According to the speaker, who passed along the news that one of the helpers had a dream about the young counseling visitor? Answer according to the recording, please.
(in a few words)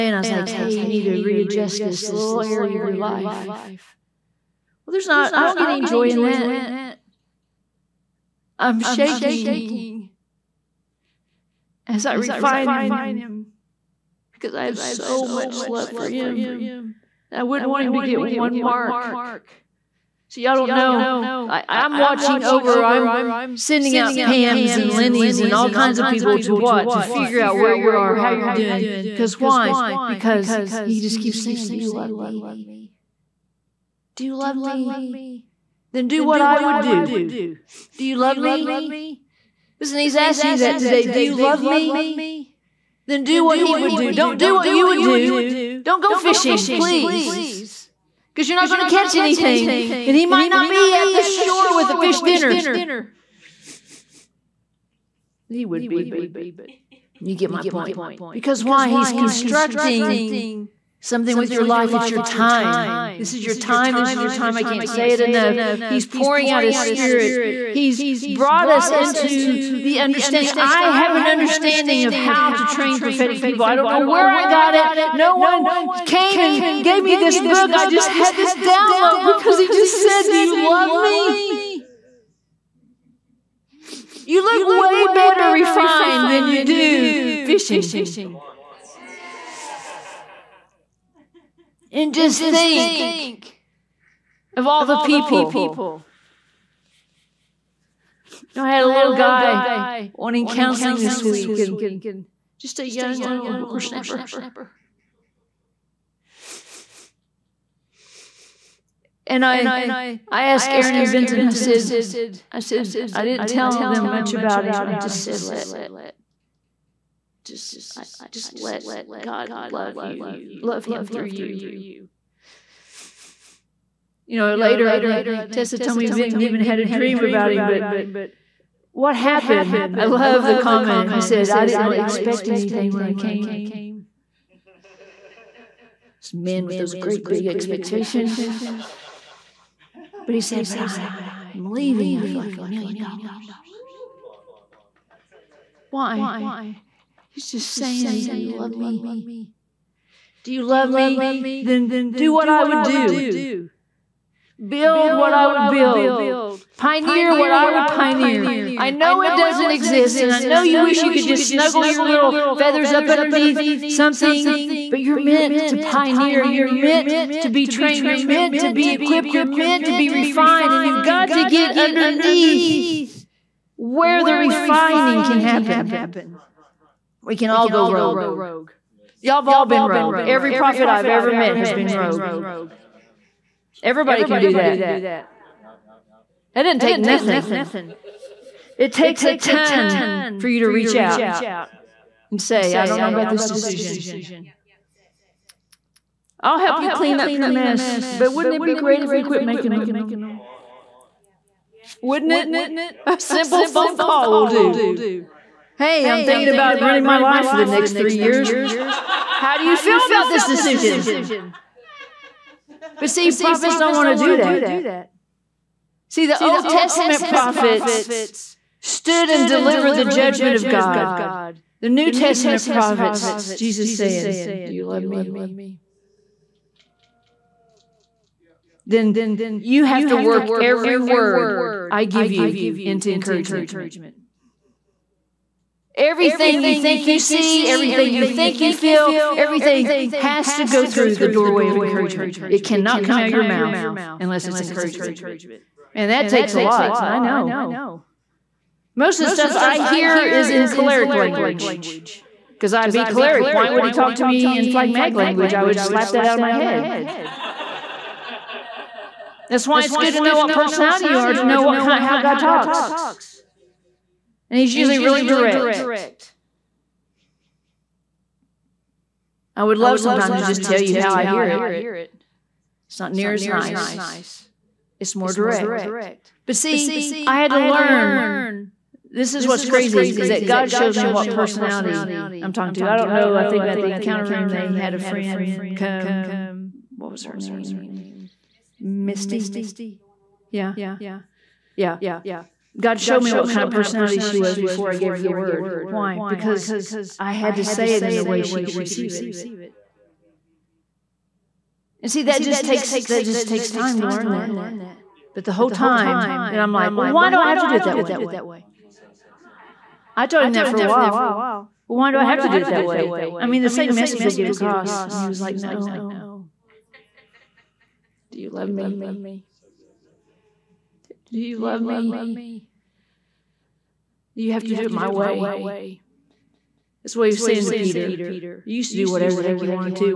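Tessa.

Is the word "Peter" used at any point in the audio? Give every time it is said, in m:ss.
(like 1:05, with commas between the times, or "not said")
5:27.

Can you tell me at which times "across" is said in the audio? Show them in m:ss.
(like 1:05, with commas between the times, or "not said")
5:14.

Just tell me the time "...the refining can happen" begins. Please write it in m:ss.
2:54.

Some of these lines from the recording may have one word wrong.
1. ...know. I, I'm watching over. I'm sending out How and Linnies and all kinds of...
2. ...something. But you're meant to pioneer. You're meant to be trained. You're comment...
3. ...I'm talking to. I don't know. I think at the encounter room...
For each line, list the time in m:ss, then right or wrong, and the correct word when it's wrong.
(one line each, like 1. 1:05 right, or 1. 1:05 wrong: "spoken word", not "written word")
1. 0:20 wrong: "Pams", not "How"
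2. 2:43 wrong: "meant", not "comment"
3. 4:42 right.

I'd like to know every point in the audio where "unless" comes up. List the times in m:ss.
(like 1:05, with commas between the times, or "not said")
4:04.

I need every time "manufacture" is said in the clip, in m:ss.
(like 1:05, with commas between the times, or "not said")
not said.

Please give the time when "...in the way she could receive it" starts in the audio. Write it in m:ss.
4:58.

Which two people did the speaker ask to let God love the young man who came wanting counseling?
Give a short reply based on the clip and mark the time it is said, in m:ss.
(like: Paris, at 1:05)
Aaron and Vinton, at 1:50.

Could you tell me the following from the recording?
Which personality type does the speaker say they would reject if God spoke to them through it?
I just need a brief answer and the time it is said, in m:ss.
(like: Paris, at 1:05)
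phlegmatic, at 4:14.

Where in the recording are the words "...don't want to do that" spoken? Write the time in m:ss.
3:33.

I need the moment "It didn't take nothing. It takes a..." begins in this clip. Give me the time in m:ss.
3:06.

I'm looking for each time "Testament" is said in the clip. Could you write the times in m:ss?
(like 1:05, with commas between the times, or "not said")
3:36, 3:42.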